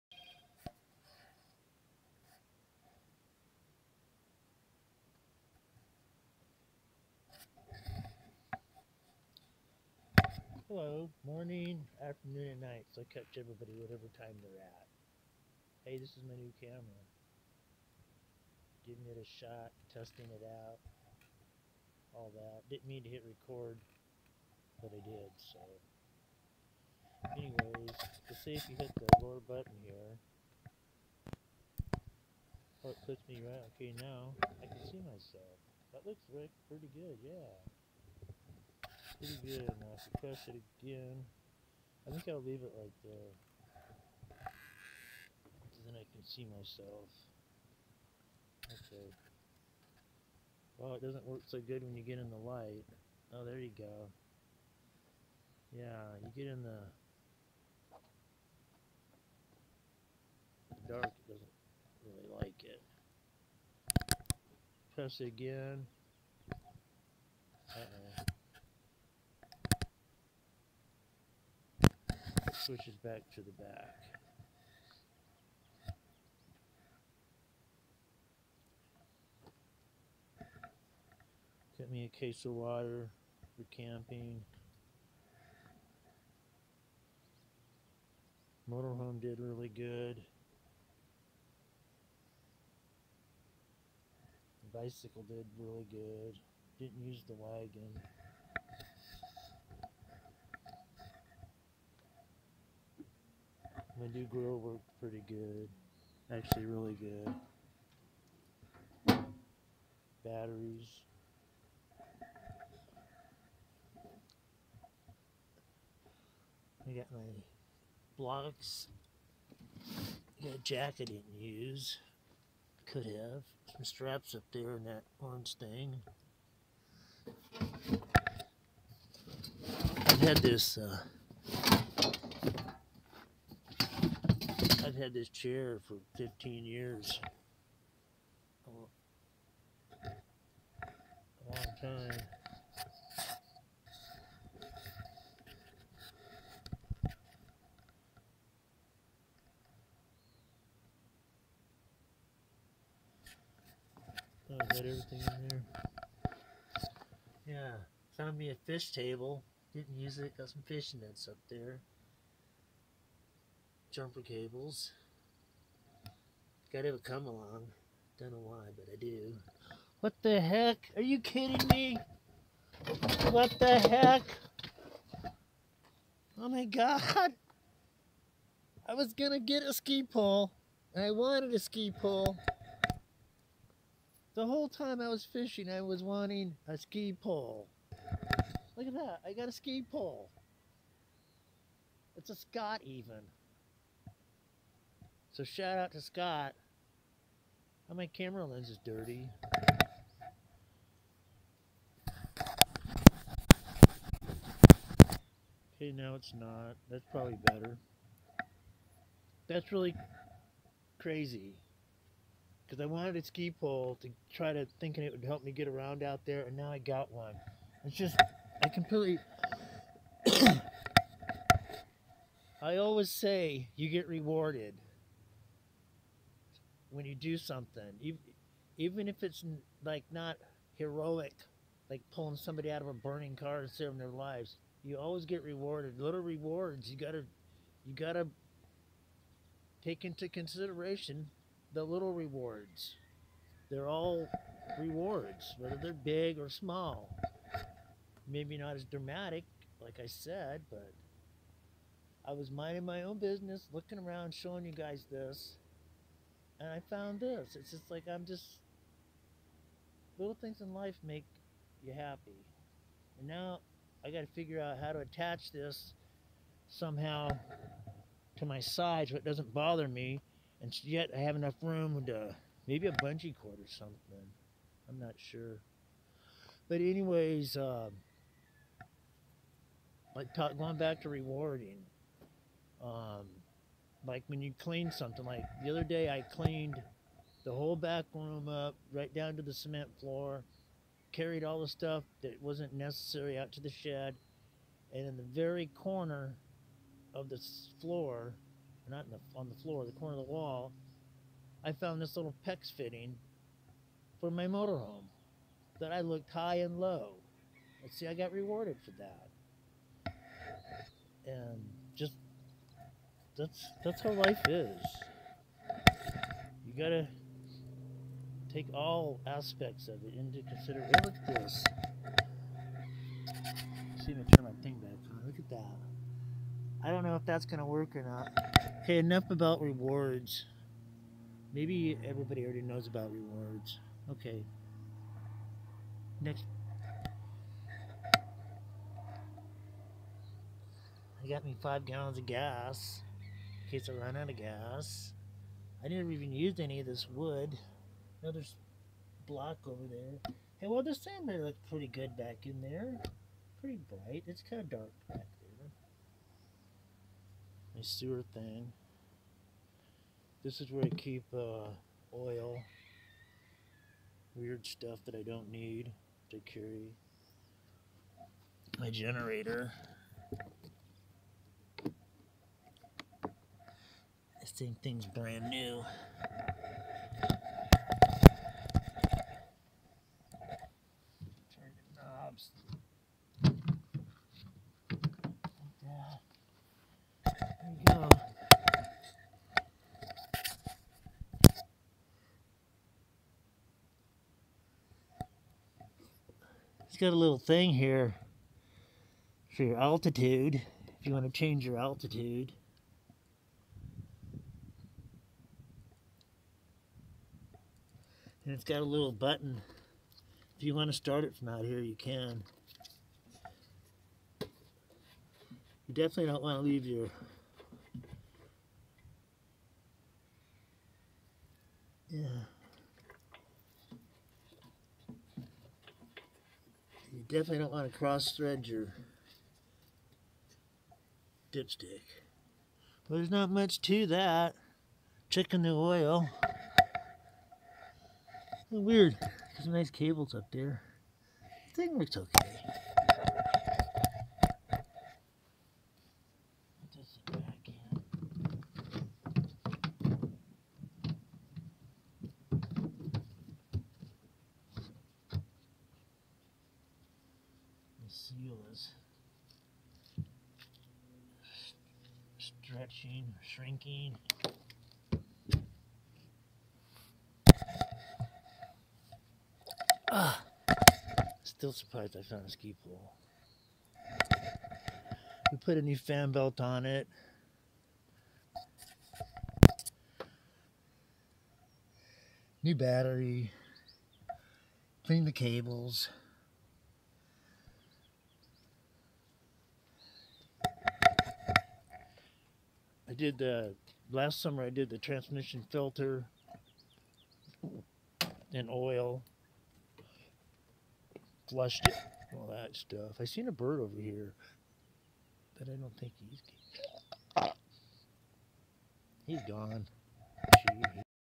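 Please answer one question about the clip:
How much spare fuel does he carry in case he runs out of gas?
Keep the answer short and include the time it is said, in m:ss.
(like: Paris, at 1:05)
5 gallons, at 5:41.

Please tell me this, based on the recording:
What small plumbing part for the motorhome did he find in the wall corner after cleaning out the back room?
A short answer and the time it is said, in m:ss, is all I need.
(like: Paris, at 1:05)
PEX fitting, at 5:02.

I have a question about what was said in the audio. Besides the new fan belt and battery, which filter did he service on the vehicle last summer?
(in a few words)
transmission filter.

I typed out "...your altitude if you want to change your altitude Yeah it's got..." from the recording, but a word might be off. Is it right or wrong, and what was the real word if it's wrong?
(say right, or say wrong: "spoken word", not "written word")
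wrong: "And", not "Yeah".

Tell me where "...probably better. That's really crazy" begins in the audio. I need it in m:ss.
3:27.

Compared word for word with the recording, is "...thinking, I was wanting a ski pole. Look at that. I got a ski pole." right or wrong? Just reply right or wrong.
wrong.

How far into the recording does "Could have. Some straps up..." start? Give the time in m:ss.
2:02.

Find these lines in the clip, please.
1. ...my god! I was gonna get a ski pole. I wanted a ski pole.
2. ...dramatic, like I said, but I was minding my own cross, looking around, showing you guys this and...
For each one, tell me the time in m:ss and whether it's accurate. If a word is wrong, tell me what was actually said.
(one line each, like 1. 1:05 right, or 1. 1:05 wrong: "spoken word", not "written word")
1. 2:56 right
2. 4:08 wrong: "business", not "cross".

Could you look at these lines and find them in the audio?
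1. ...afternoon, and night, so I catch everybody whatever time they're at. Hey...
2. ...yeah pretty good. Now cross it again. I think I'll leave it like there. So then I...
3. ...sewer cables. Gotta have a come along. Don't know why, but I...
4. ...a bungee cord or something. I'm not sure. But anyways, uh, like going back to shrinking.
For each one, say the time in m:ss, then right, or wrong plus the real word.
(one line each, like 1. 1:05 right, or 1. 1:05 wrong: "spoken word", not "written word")
1. 0:12 right
2. 0:37 wrong: "suppress", not "cross"
3. 2:43 wrong: "jumper", not "sewer"
4. 4:32 wrong: "rewarding", not "shrinking".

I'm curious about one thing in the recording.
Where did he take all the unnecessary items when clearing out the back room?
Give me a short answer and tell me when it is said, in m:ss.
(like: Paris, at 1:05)
the shed, at 4:53.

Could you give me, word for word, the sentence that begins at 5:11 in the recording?
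And just that's that's how life is.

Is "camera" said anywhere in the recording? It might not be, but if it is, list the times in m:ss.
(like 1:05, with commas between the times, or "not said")
0:16, 3:18.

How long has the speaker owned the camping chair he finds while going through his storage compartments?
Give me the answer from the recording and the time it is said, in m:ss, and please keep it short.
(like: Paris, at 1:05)
15 years, at 2:16.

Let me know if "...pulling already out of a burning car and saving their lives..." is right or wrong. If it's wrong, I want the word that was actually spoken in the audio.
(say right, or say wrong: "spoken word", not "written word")
wrong: "somebody", not "already".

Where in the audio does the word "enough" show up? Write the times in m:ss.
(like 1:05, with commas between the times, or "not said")
4:31, 5:28.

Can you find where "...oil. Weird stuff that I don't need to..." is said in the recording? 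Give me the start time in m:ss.
6:02.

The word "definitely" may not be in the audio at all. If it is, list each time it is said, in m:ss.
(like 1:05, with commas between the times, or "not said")
6:55, 7:07.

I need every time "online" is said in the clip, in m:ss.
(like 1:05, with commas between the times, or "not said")
not said.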